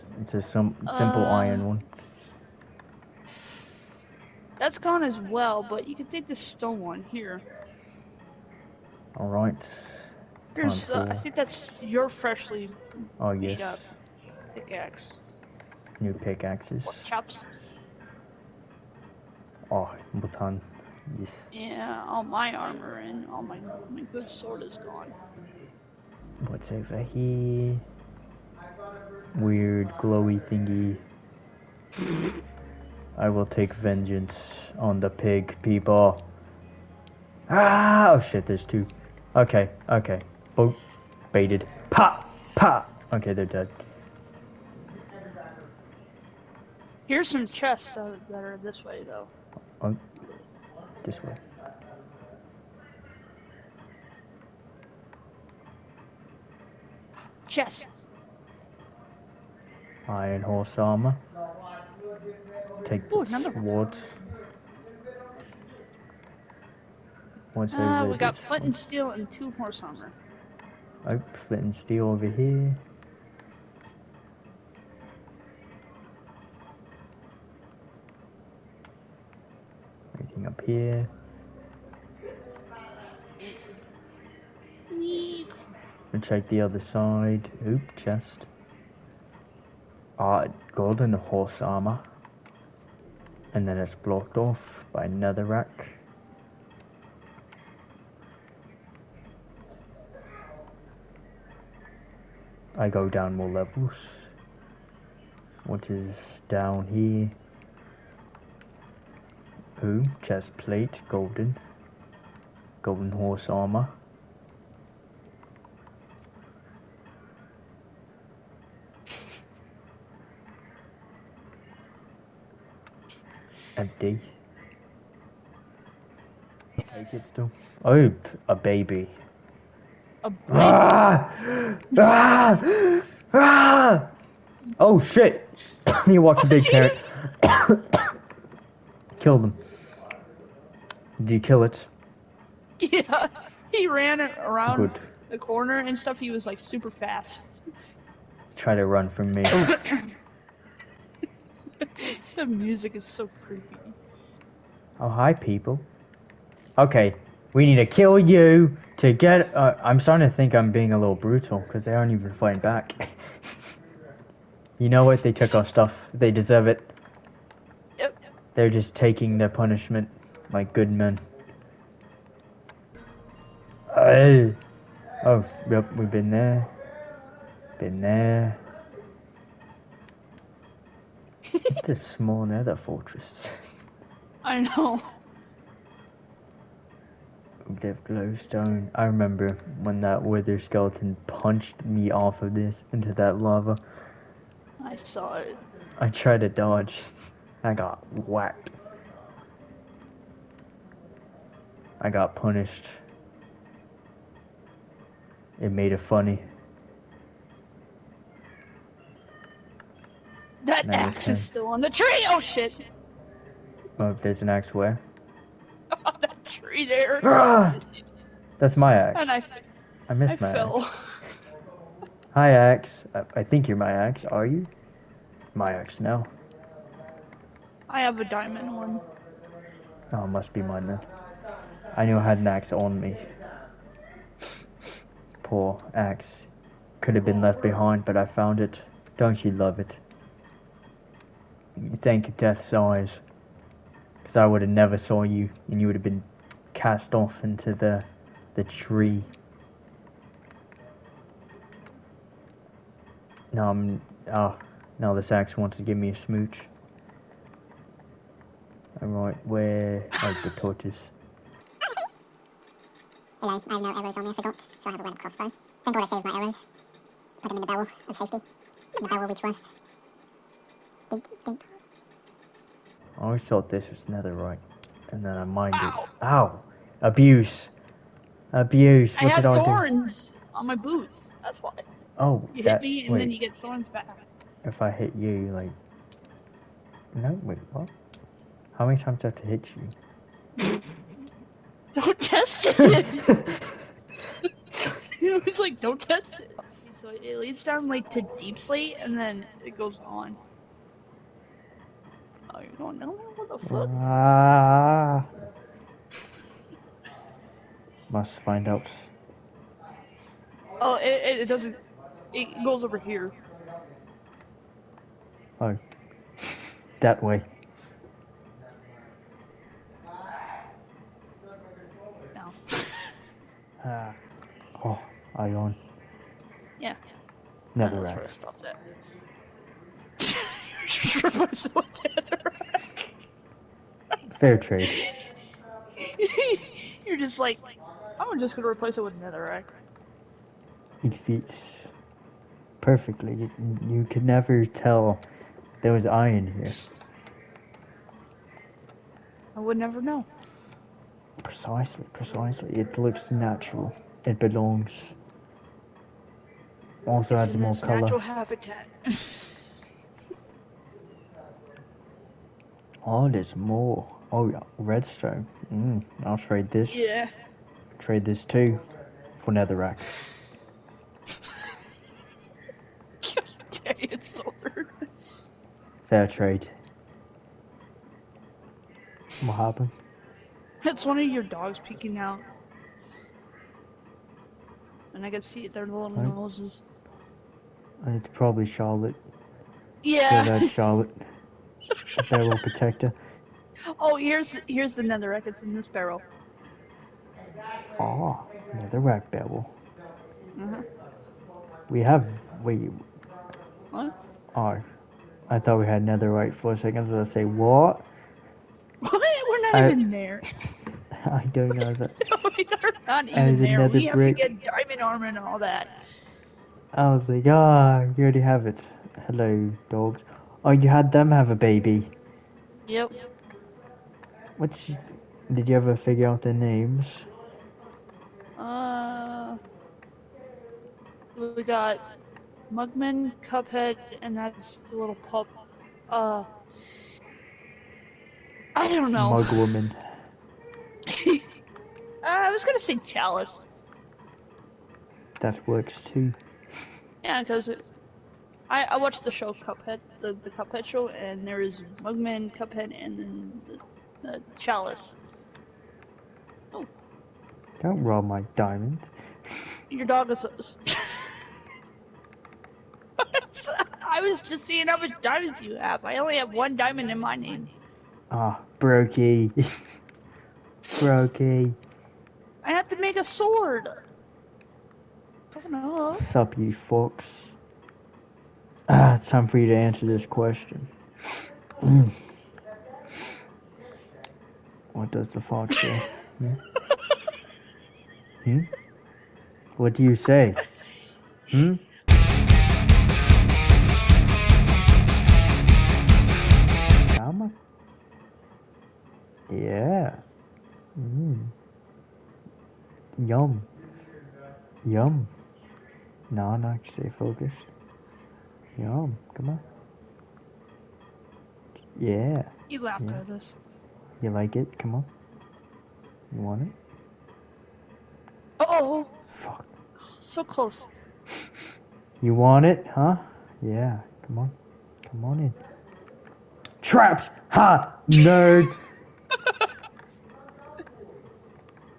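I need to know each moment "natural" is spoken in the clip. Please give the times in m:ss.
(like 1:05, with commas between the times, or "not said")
5:53, 5:58.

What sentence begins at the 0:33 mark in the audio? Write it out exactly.
I will take vengeance on the pig people.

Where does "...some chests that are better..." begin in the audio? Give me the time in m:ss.
0:47.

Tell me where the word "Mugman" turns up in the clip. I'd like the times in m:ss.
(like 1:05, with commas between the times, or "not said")
7:12, 7:32.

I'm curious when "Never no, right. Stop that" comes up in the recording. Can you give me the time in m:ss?
5:27.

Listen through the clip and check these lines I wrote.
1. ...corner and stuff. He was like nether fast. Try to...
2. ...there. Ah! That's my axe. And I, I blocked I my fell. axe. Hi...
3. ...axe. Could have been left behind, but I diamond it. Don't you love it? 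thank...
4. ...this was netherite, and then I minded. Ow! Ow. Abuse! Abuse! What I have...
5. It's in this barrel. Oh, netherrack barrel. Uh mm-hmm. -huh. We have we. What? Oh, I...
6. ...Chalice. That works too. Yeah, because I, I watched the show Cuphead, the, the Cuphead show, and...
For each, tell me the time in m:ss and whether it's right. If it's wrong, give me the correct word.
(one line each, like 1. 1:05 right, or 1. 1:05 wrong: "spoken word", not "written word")
1. 2:25 wrong: "super", not "nether"
2. 3:36 wrong: "missed", not "blocked"
3. 3:55 wrong: "found", not "diamond"
4. 4:33 right
5. 6:35 right
6. 7:23 right.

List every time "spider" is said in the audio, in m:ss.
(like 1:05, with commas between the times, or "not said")
not said.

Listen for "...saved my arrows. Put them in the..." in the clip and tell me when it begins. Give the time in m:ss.
4:26.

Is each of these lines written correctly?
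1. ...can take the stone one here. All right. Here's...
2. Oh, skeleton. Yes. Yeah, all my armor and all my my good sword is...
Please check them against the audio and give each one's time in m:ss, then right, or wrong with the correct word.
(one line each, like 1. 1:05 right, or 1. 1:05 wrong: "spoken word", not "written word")
1. 0:05 right
2. 0:19 wrong: "baton", not "skeleton".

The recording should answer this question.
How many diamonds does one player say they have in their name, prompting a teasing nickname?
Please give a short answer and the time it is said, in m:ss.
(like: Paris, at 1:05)
1, at 7:46.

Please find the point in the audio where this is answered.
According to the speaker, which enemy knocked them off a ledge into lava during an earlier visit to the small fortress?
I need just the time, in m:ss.
3:10.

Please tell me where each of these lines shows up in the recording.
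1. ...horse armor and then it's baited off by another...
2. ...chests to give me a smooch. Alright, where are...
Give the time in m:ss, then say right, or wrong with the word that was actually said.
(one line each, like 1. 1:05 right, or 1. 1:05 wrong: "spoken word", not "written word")
1. 1:31 wrong: "blocked", not "baited"
2. 4:15 wrong: "wants", not "chests".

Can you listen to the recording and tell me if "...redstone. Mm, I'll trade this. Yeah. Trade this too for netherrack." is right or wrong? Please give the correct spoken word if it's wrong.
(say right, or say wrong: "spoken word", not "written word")
right.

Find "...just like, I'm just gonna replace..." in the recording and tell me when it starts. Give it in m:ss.
5:37.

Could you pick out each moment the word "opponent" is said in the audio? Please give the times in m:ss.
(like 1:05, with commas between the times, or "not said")
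not said.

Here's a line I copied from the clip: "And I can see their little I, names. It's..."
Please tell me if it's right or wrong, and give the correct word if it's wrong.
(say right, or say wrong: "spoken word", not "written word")
wrong: "noses", not "names".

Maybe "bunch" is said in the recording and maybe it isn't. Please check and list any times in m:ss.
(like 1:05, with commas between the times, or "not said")
not said.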